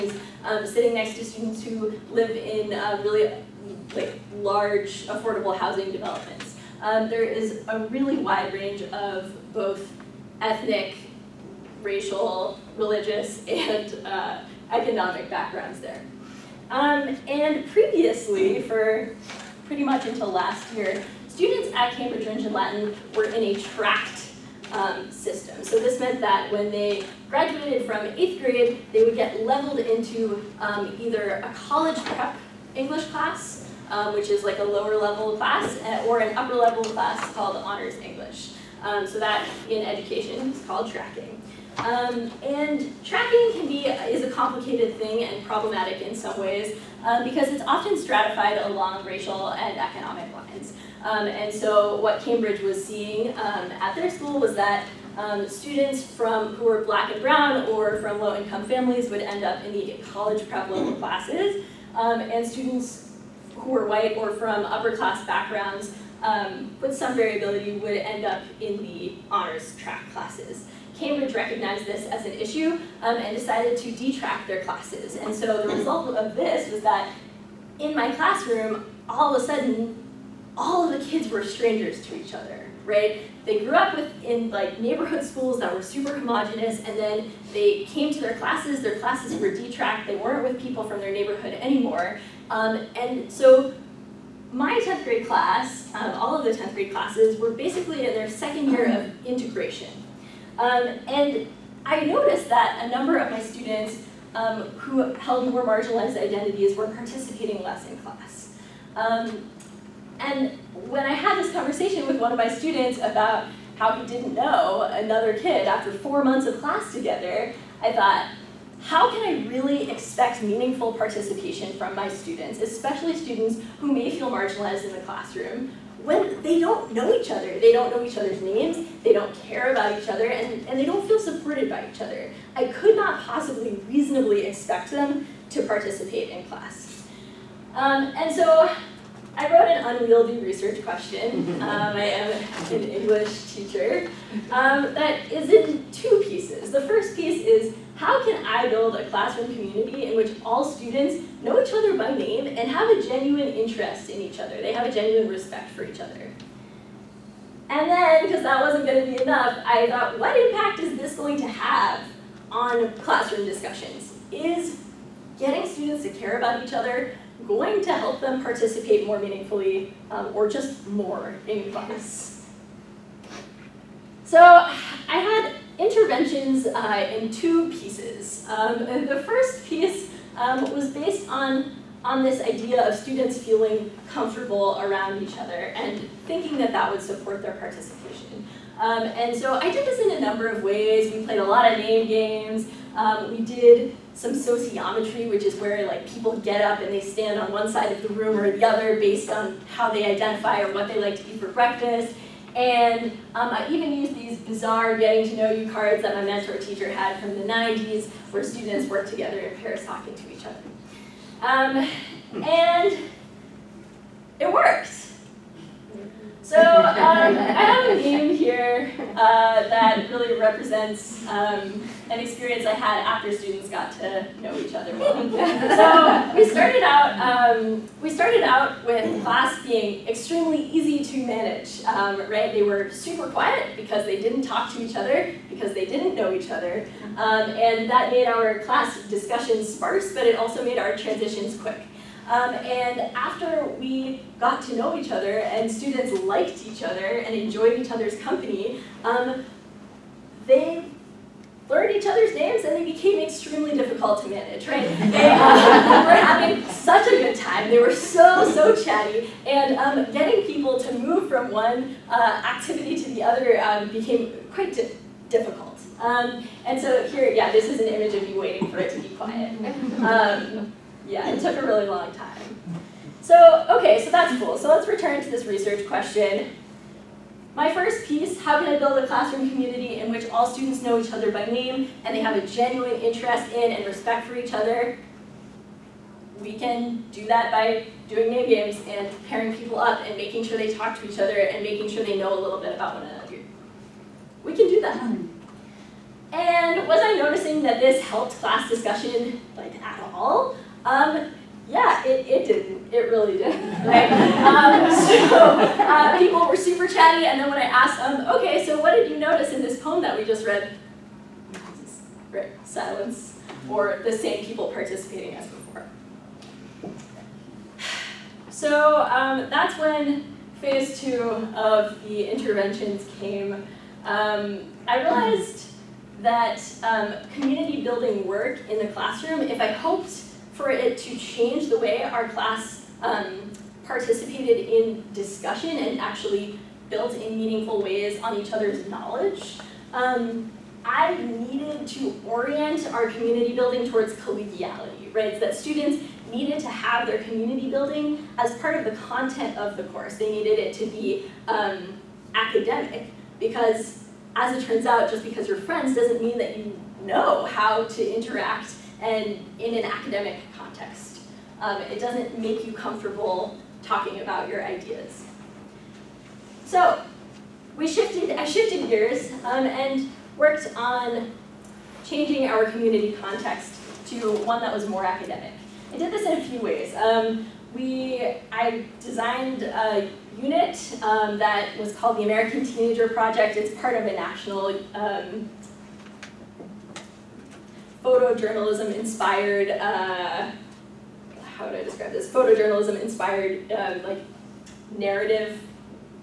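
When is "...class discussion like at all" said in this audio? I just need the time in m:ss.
4:58.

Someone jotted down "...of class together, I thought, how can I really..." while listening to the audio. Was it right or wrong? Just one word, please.
right.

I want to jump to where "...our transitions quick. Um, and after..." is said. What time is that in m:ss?
4:00.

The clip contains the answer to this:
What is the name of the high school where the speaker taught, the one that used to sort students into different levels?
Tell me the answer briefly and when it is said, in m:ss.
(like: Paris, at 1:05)
Cambridge Rindge and Latin, at 0:21.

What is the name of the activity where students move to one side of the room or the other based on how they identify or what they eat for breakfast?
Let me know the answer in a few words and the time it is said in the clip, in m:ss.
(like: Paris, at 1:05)
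Sociometry, at 3:14.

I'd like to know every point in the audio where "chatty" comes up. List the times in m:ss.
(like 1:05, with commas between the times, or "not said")
4:18, 5:06.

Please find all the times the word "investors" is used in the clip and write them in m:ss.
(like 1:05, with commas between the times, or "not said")
not said.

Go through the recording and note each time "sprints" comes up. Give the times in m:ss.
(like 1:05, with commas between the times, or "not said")
not said.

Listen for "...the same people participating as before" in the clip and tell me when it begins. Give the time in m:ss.
5:14.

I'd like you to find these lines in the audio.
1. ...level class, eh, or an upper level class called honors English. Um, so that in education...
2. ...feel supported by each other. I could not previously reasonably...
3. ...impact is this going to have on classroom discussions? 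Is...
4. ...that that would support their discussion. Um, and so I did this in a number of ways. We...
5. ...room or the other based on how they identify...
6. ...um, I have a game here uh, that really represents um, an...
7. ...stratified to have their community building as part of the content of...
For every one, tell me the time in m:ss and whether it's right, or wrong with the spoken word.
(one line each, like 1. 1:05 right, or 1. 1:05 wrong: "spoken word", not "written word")
1. 0:34 right
2. 2:11 wrong: "possibly", not "previously"
3. 2:40 right
4. 3:06 wrong: "participation", not "discussion"
5. 3:18 right
6. 3:36 right
7. 5:46 wrong: "needed", not "stratified".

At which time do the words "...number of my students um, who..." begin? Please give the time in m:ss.
1:42.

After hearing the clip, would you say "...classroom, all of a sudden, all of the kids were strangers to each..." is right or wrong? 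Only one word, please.
right.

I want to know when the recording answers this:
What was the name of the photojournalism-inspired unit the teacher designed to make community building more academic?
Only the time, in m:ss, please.
6:22.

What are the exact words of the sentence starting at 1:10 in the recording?
Cambridge recognized this as an issue um, and decided to detract their classes.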